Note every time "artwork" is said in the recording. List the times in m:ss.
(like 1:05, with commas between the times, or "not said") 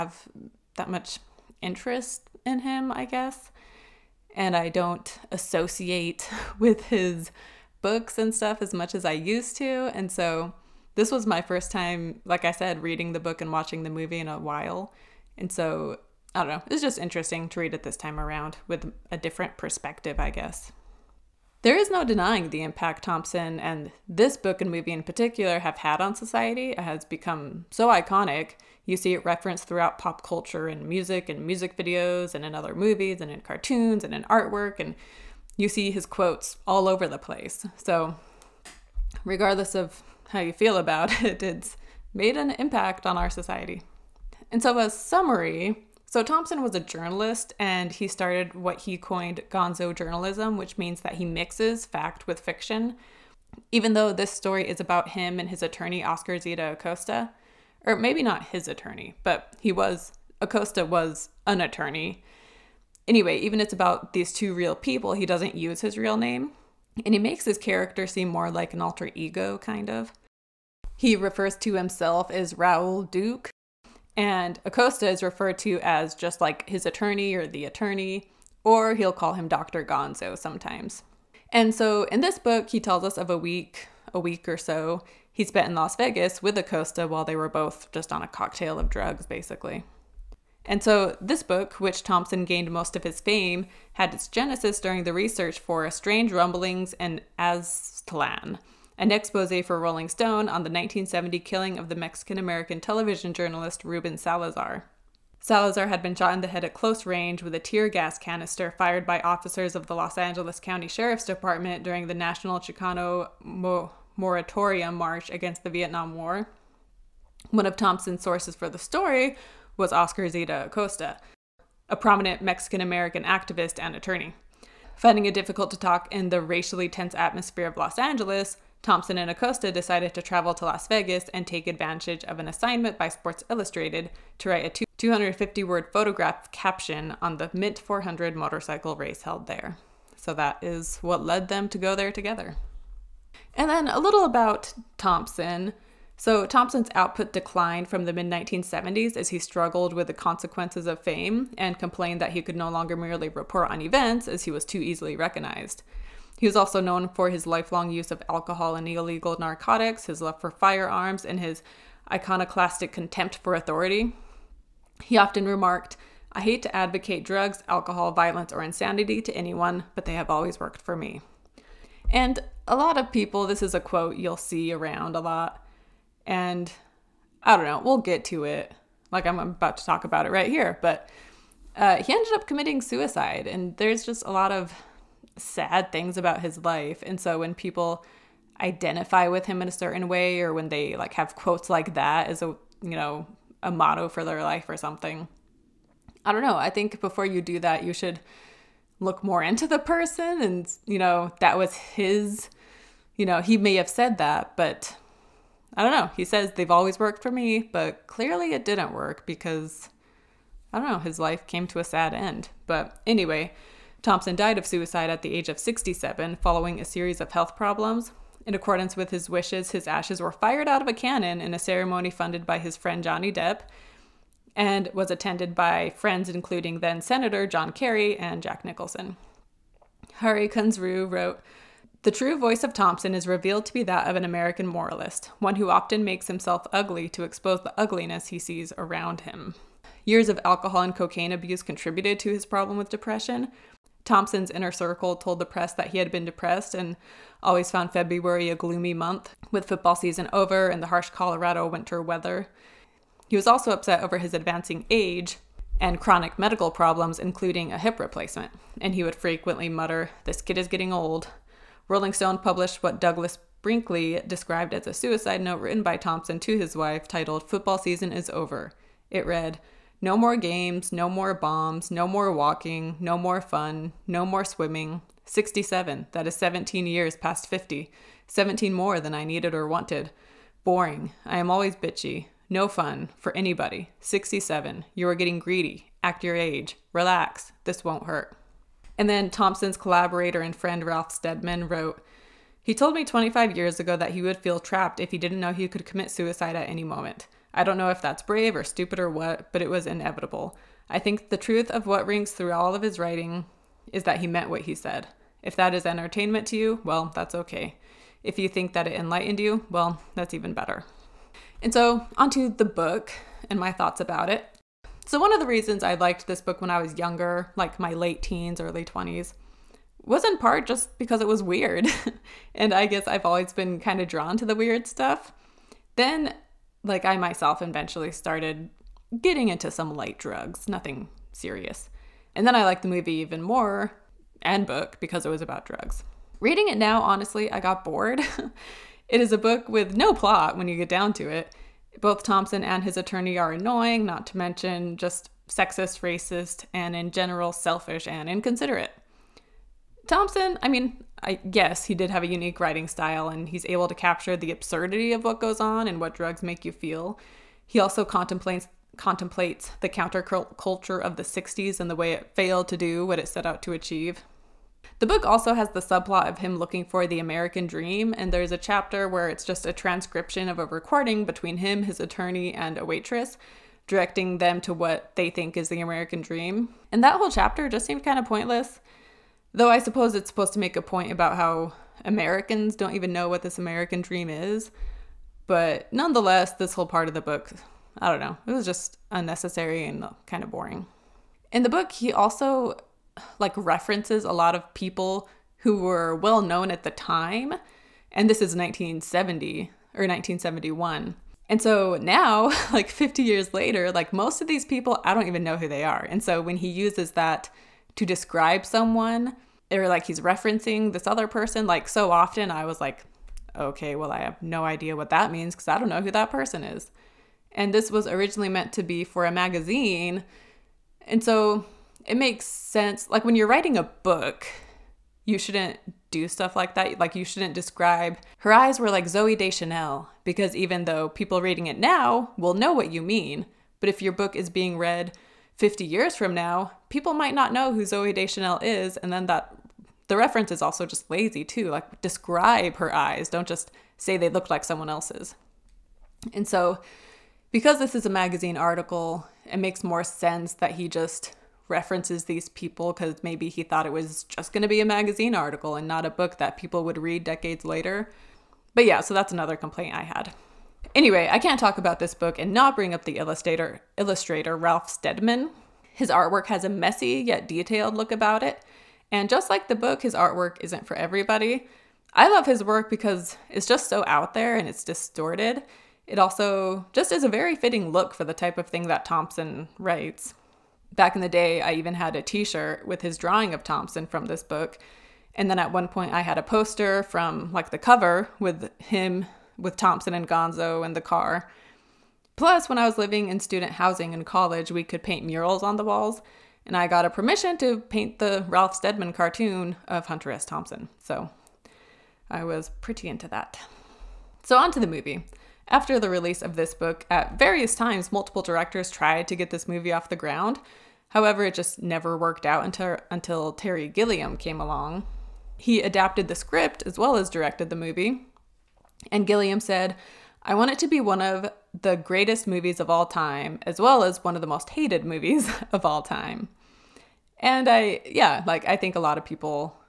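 0:34, 7:46, 7:50.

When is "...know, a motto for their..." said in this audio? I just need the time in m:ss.
3:12.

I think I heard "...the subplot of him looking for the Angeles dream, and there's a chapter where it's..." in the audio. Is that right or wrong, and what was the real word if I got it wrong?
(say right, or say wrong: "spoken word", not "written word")
wrong: "American", not "Angeles".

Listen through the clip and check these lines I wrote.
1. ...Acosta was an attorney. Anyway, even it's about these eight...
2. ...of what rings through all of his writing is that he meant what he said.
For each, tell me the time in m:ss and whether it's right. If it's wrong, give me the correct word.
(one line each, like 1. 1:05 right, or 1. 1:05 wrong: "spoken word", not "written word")
1. 1:00 wrong: "two", not "eight"
2. 5:01 right.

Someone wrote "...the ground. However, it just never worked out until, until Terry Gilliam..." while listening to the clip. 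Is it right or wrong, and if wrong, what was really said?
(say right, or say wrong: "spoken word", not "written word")
right.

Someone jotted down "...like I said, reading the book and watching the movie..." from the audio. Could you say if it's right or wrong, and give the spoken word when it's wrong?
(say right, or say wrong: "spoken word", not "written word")
right.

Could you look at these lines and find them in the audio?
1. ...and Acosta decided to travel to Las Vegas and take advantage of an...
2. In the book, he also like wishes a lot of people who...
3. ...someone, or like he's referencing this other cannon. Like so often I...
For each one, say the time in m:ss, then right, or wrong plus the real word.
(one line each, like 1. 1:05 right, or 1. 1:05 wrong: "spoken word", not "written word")
1. 2:09 right
2. 6:31 wrong: "references", not "wishes"
3. 6:48 wrong: "person", not "cannon".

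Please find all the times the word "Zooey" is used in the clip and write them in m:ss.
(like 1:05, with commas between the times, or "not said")
7:09, 7:17.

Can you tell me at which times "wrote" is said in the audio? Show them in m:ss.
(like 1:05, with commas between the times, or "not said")
3:51, 4:51.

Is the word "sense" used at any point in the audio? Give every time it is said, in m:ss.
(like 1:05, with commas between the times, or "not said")
7:02, 7:30.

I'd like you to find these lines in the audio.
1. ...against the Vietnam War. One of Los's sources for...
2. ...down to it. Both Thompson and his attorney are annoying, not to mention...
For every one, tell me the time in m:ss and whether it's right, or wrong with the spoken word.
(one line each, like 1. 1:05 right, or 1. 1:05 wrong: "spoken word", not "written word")
1. 1:55 wrong: "Thompson", not "Los"
2. 5:40 right.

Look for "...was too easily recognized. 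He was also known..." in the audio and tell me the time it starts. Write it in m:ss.
2:34.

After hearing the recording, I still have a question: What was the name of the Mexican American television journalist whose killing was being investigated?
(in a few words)
Ruben Salazar.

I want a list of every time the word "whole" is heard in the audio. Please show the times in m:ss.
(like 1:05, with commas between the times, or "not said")
6:17, 6:26.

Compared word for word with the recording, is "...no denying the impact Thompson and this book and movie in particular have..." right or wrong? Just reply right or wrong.
right.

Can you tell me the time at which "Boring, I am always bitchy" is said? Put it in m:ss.
4:40.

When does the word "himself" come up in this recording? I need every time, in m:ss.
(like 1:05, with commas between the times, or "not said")
1:11, 3:56.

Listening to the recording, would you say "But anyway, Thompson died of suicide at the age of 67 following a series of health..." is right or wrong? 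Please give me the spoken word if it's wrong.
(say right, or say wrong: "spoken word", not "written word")
right.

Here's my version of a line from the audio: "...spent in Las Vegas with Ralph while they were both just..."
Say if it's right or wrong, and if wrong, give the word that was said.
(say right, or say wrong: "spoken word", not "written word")
wrong: "Acosta", not "Ralph".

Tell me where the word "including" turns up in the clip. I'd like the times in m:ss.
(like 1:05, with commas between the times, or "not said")
3:46, 4:17.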